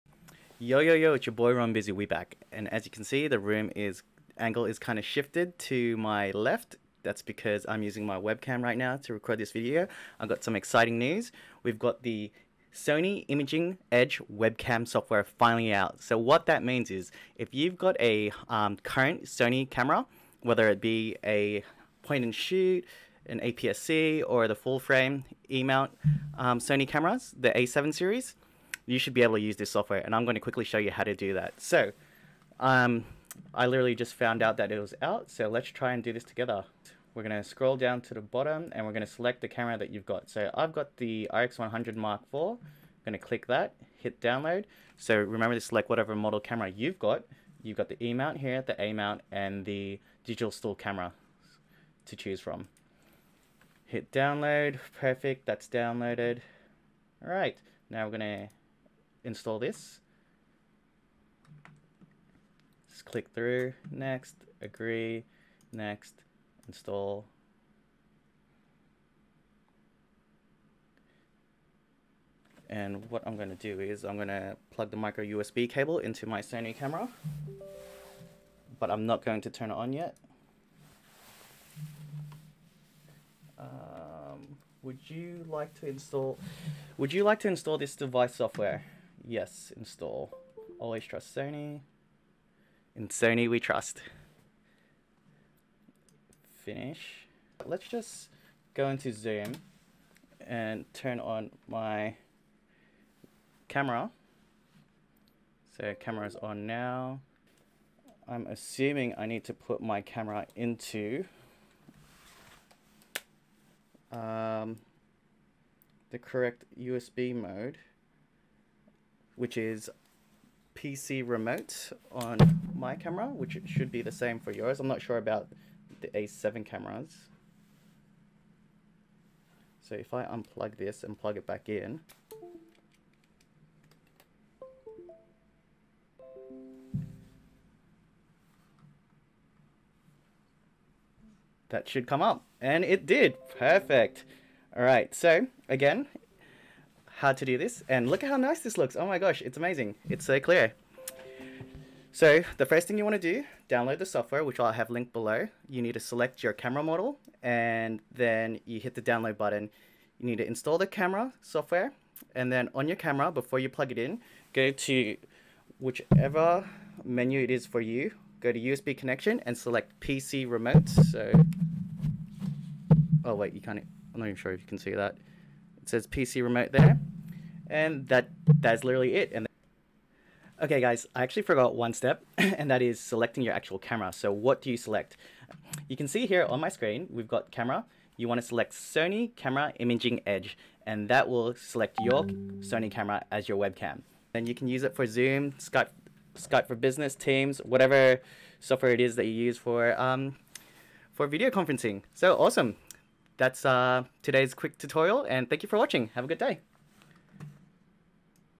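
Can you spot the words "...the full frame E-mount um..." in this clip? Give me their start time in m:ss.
0:24.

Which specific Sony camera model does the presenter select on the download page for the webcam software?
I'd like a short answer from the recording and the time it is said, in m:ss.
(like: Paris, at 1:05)
RX100 Mark IV, at 0:41.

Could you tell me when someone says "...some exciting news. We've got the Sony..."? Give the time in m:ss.
0:10.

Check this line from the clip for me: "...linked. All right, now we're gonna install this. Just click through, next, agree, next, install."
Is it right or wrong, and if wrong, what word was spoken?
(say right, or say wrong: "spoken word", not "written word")
wrong: "downloaded", not "linked".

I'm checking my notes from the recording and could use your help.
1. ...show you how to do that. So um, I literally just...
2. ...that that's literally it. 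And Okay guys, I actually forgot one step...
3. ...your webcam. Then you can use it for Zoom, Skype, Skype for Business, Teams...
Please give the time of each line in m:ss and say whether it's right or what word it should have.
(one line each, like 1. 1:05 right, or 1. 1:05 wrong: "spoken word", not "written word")
1. 0:30 right
2. 2:58 right
3. 3:13 right.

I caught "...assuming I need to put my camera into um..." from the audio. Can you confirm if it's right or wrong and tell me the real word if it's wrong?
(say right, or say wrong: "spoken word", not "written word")
right.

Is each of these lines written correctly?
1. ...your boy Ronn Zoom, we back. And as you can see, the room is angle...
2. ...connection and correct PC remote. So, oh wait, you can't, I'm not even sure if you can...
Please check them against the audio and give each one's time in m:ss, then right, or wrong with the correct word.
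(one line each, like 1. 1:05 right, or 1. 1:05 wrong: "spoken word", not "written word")
1. 0:01 wrong: "Bizzy", not "Zoom"
2. 2:48 wrong: "select", not "correct".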